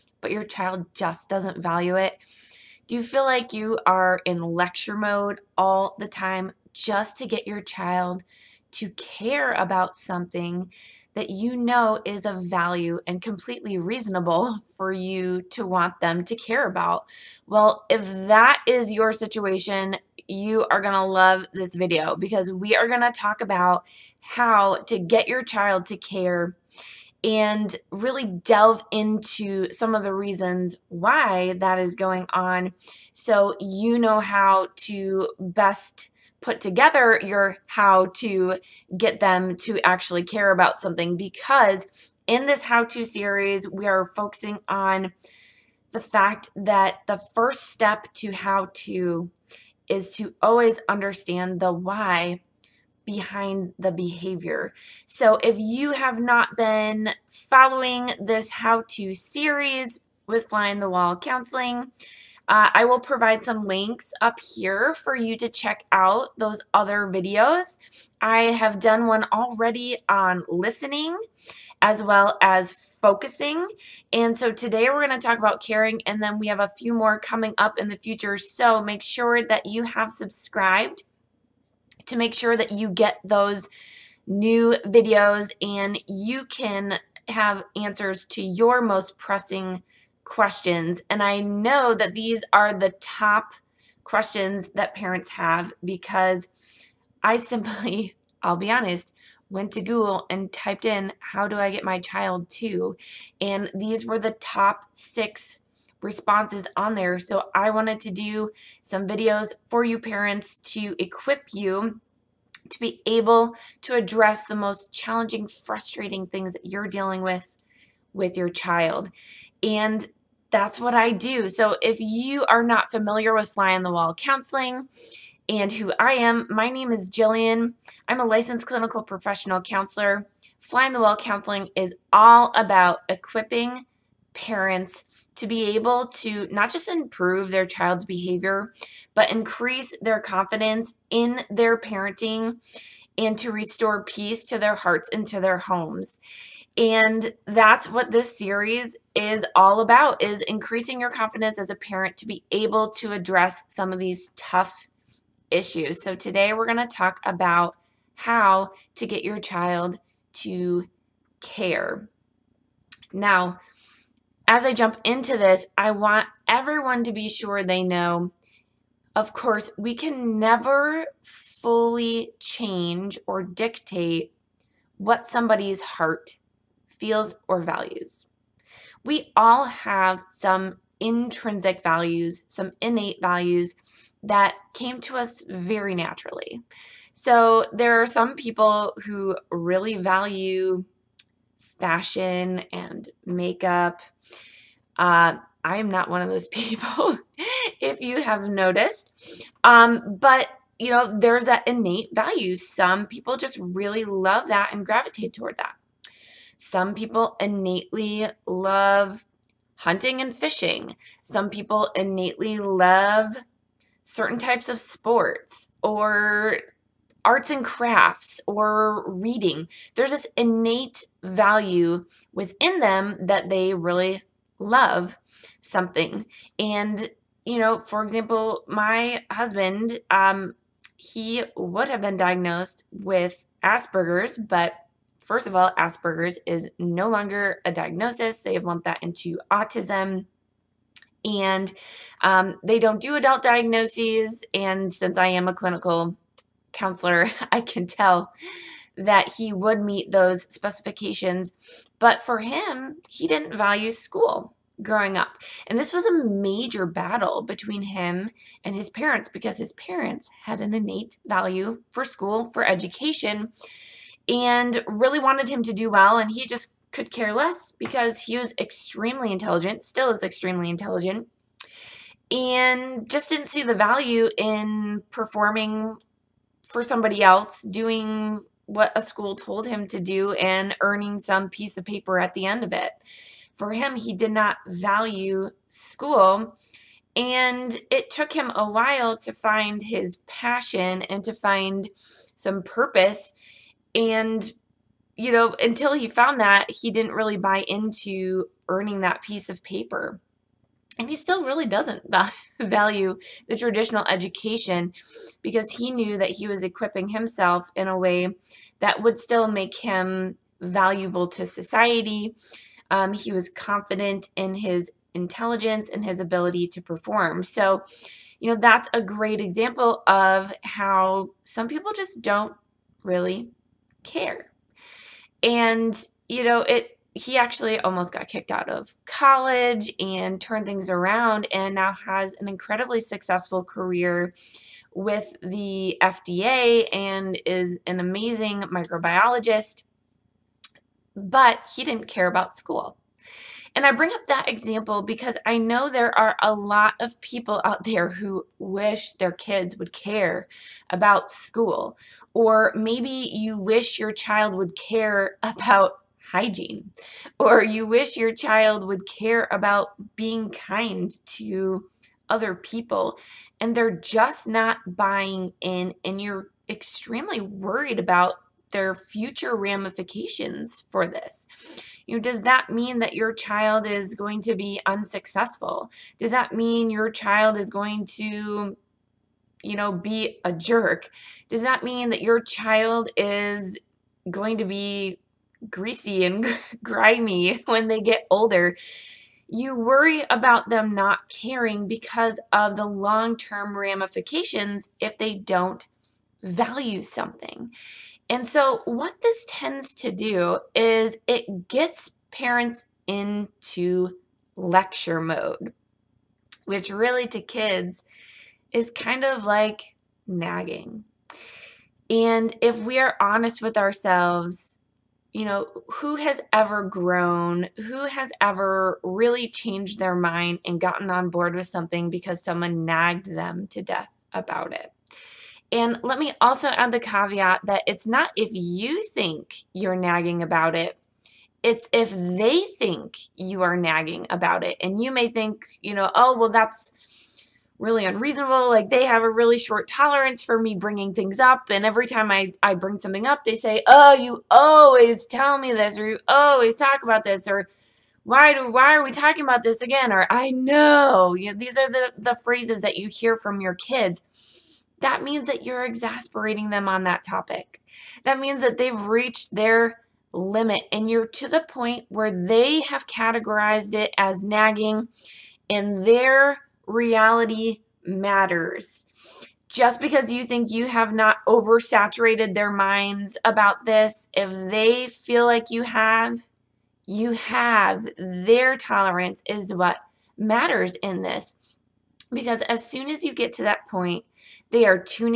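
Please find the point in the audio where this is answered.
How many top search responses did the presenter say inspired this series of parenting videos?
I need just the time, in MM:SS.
01:44.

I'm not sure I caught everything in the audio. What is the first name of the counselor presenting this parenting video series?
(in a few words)
Jillian.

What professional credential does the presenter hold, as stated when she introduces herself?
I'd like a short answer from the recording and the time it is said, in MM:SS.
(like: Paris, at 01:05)
Licensed clinical professional counselor, at 02:08.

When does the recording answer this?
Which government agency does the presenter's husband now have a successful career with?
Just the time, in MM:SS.
05:36.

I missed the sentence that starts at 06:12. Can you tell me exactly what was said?
You know, does that mean that your child is going to be unsuccessful?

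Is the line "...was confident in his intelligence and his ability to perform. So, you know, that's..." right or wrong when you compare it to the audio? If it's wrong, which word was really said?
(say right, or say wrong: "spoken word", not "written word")
right.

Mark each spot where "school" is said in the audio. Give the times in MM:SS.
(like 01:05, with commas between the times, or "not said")
04:13, 04:22, 04:39, 04:45, 05:42, 05:51.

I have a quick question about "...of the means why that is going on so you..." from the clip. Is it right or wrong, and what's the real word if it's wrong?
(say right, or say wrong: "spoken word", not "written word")
wrong: "reasons", not "means".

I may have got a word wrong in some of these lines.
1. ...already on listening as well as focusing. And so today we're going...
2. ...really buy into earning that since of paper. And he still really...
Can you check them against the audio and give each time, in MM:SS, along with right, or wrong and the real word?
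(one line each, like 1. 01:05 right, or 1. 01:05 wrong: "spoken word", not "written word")
1. 01:09 right
2. 04:57 wrong: "piece", not "since".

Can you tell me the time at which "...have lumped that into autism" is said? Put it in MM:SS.
03:58.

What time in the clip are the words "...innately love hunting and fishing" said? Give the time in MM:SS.
03:27.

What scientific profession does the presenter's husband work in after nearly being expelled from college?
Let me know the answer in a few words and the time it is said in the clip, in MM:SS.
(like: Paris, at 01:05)
Microbiologist, at 05:38.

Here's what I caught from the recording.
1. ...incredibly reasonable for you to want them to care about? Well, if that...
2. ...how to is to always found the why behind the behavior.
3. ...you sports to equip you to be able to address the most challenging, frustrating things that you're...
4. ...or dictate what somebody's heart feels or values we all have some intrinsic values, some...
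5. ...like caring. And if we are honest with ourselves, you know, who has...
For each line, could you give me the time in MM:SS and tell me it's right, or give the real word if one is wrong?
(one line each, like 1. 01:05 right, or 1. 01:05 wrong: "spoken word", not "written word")
1. 00:13 wrong: "completely", not "incredibly"
2. 00:48 wrong: "understand", not "found"
3. 01:49 wrong: "parents", not "sports"
4. 02:53 right
5. 06:49 wrong: "nagging", not "caring".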